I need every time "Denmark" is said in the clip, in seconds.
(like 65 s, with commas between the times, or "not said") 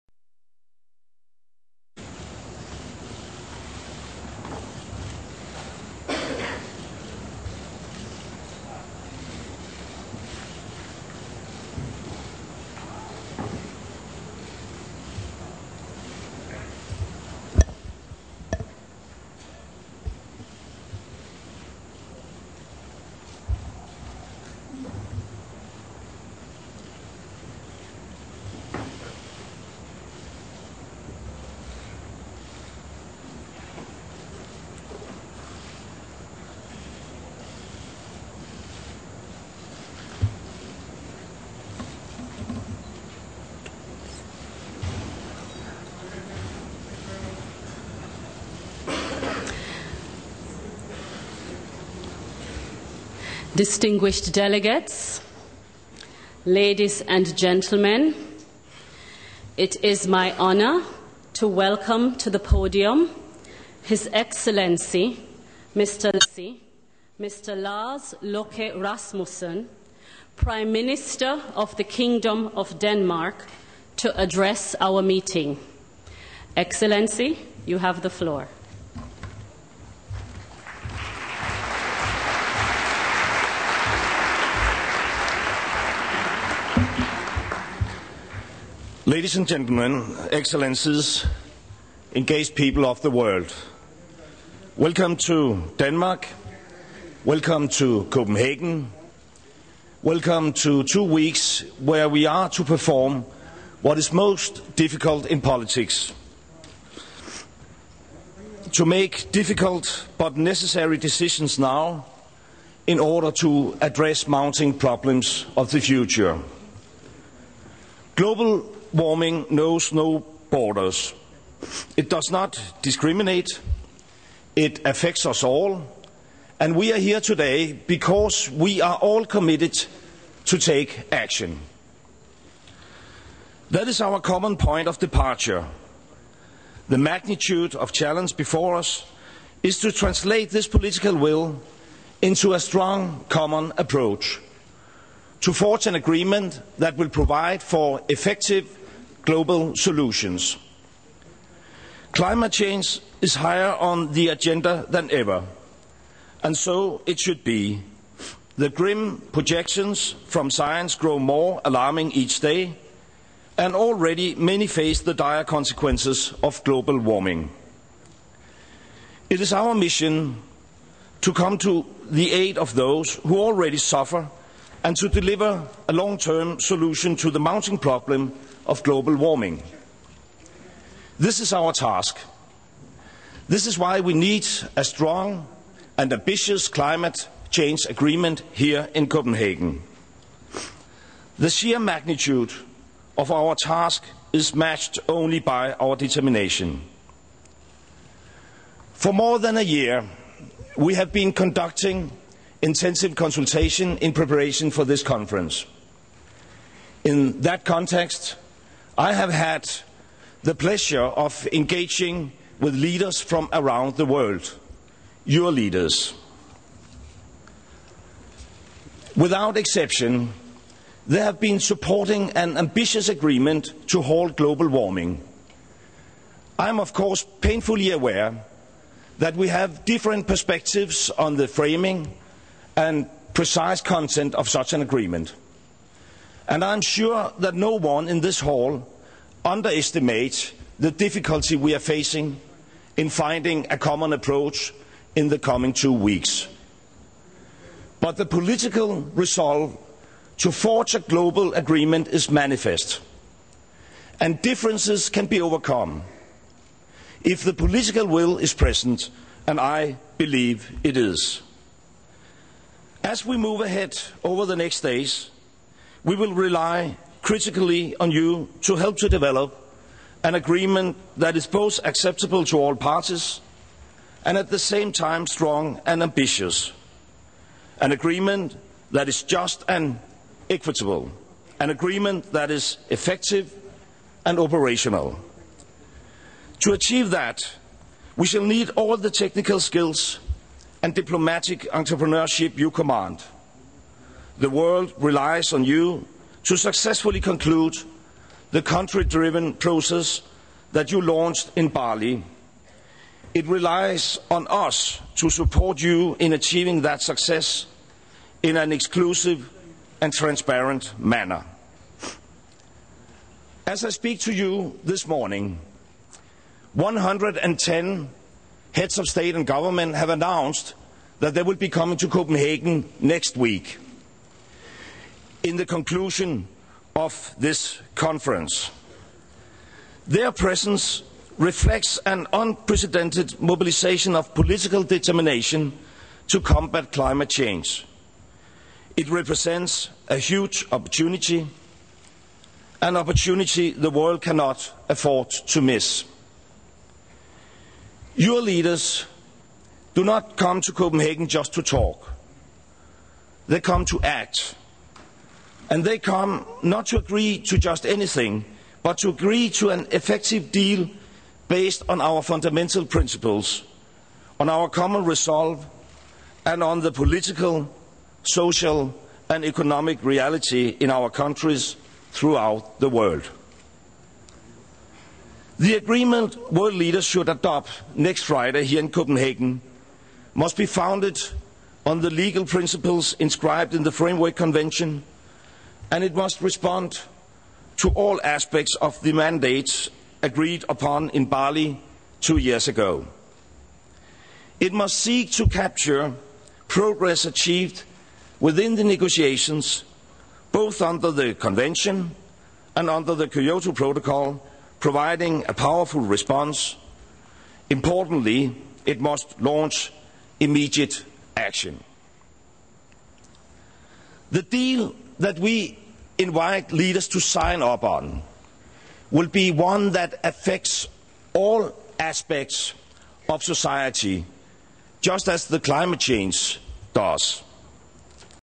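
72 s, 95 s.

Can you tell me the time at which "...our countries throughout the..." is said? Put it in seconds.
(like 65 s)
370 s.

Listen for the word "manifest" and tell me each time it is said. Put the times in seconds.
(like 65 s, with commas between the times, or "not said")
252 s.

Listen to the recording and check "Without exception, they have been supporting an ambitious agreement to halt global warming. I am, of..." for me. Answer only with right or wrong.
right.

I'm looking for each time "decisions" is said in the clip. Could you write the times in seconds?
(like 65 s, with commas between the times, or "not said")
110 s.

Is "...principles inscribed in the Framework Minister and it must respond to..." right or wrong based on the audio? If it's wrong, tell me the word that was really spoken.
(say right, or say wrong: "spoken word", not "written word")
wrong: "Convention", not "Minister".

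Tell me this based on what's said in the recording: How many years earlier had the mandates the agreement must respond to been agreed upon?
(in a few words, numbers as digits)
2.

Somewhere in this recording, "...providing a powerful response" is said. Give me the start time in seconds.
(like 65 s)
404 s.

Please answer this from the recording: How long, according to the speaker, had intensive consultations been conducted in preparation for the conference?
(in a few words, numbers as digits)
More than a year.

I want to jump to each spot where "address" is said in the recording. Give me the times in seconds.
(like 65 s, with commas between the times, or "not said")
74 s, 113 s.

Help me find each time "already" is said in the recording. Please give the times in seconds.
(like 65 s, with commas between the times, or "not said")
163 s, 173 s.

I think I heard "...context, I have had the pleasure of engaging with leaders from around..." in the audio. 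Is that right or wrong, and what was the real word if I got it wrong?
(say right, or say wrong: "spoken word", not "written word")
right.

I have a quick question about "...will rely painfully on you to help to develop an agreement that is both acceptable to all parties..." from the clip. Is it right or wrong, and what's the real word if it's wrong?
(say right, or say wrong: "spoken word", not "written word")
wrong: "critically", not "painfully".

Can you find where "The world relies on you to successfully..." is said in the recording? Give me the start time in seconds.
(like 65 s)
294 s.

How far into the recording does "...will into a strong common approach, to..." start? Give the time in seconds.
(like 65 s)
141 s.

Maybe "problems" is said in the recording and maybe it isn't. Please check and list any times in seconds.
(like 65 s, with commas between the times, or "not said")
114 s, 177 s.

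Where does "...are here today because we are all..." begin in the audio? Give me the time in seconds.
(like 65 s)
126 s.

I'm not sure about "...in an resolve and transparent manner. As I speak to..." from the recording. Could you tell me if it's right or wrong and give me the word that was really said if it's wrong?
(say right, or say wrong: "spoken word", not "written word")
wrong: "exclusive", not "resolve".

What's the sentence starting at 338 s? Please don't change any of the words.
It represents a huge opportunity, an opportunity the world cannot afford to miss.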